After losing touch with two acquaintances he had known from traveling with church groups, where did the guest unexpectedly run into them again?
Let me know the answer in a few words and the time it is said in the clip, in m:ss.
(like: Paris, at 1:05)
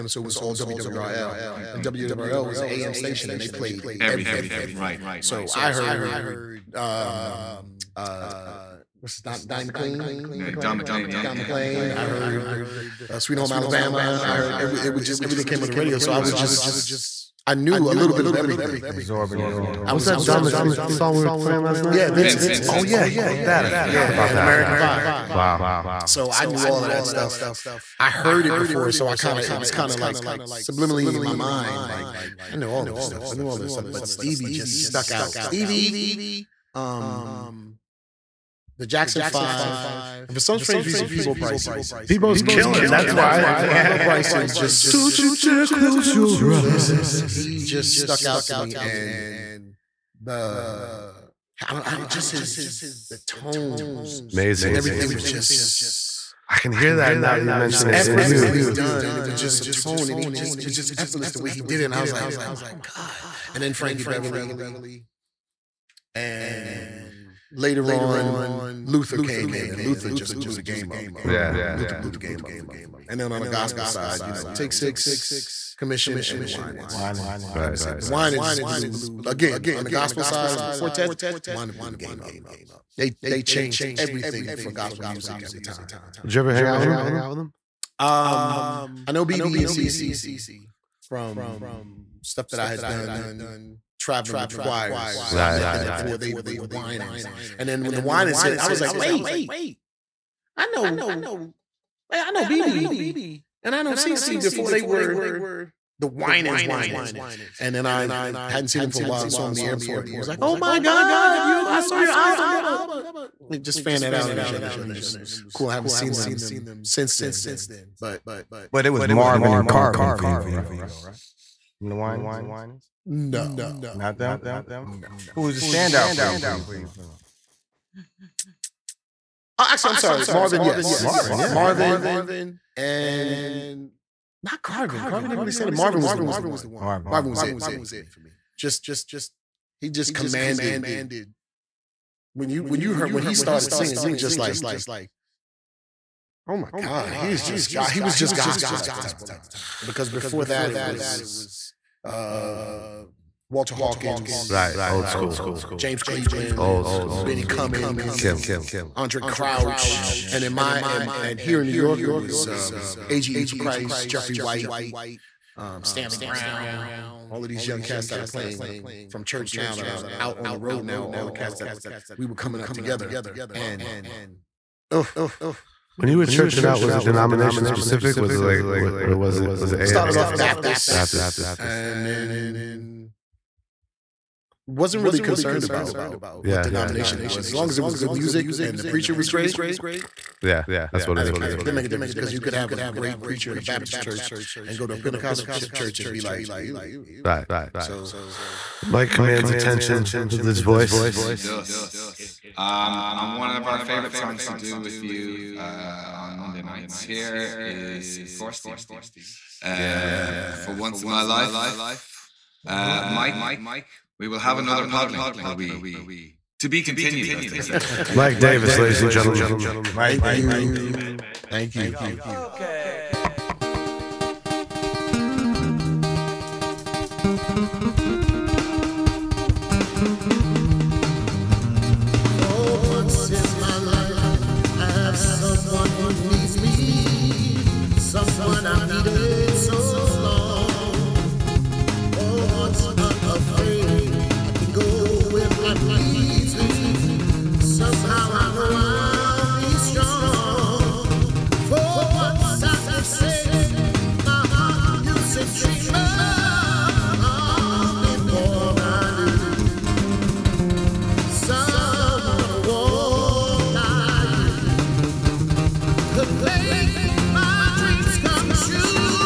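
the airport, at 1:49.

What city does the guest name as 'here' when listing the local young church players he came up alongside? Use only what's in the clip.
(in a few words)
New York.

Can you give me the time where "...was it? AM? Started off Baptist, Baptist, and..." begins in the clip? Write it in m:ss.
2:59.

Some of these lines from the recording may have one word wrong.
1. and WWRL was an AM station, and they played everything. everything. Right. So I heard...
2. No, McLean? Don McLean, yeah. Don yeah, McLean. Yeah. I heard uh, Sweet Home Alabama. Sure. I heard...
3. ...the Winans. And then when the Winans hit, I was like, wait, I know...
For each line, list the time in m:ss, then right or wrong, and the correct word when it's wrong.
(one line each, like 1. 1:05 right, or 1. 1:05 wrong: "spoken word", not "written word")
1. 0:01 right
2. 0:10 right
3. 1:36 right.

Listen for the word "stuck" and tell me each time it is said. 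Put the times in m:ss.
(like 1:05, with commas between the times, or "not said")
0:34, 0:47.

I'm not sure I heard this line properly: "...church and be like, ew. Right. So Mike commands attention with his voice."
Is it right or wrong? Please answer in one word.
right.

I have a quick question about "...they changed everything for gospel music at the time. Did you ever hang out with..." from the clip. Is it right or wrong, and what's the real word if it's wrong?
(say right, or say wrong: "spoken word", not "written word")
right.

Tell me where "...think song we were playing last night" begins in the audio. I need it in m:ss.
0:20.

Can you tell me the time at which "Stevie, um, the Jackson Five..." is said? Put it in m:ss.
0:35.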